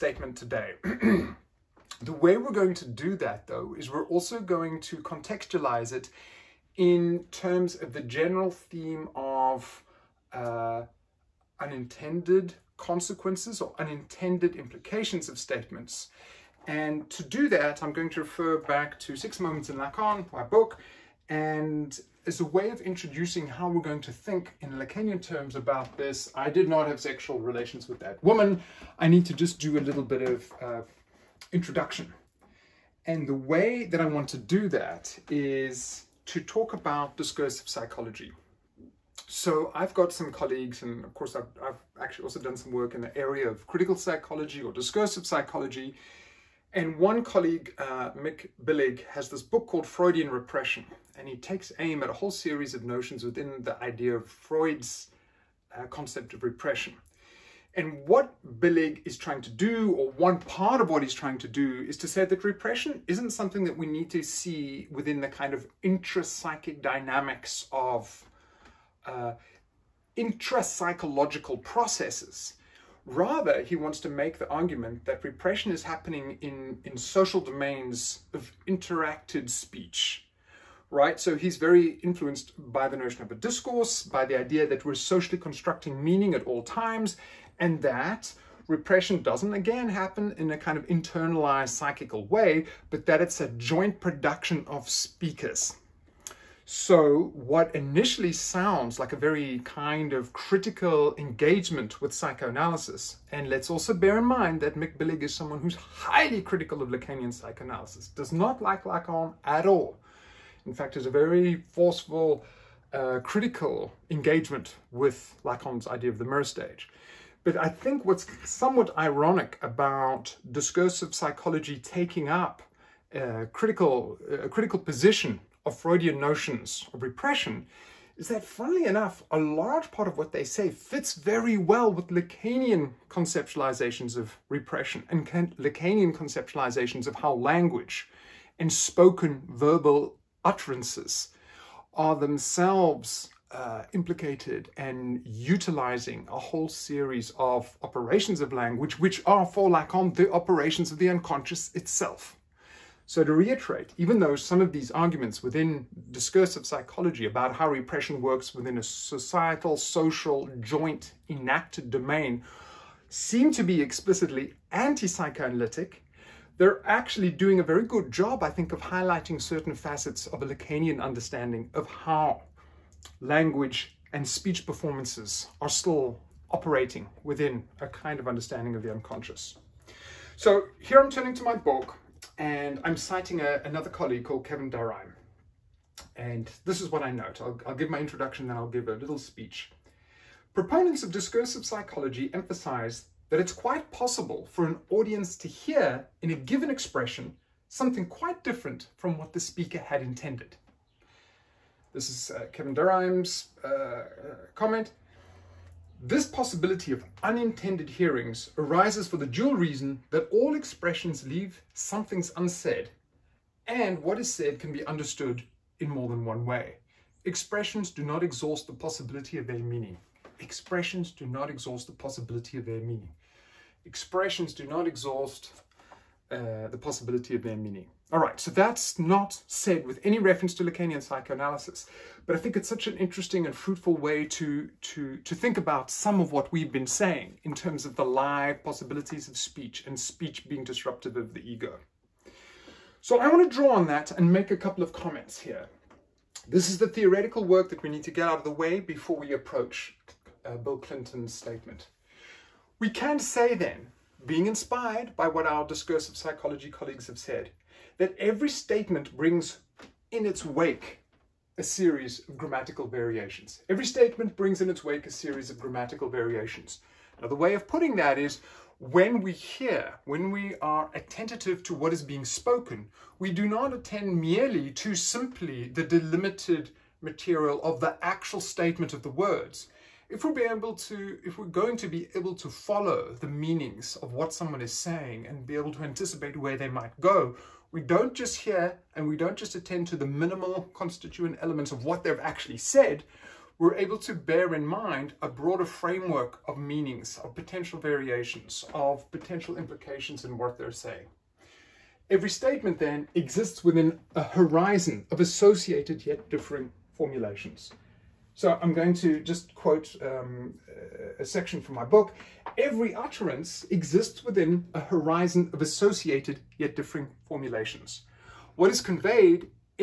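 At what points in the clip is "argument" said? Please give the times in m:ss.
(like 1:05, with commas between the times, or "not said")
1:14, 2:34.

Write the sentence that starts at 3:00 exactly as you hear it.
So here I'm turning to my book and I'm citing a, another colleague called Kevin Durrheim.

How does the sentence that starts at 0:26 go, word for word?
I did not have sexual relations with that woman.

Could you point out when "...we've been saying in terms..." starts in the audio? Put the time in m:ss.
3:56.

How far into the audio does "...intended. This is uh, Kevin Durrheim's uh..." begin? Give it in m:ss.
3:20.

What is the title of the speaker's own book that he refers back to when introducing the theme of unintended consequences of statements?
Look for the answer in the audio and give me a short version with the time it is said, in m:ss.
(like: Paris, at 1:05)
Six Moments in Lacan, at 0:19.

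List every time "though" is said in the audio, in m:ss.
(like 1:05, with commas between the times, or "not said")
0:03, 2:34.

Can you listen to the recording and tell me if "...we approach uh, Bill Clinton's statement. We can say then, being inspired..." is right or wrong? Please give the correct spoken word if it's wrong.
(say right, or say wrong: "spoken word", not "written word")
right.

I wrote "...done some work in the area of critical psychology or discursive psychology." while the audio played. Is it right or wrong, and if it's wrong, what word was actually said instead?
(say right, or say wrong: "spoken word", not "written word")
right.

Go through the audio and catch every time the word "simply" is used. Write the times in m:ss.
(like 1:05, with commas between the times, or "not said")
4:34.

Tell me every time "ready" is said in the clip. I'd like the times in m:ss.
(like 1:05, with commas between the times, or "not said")
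not said.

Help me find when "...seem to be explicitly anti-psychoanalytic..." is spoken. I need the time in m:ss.
2:43.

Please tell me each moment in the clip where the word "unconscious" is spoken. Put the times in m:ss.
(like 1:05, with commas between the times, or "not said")
2:31, 2:58.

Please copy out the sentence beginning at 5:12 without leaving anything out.
Every utterance exists within a horizon of associated yet differing formulations.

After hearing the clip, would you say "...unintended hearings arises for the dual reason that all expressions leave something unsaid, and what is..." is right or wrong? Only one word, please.
right.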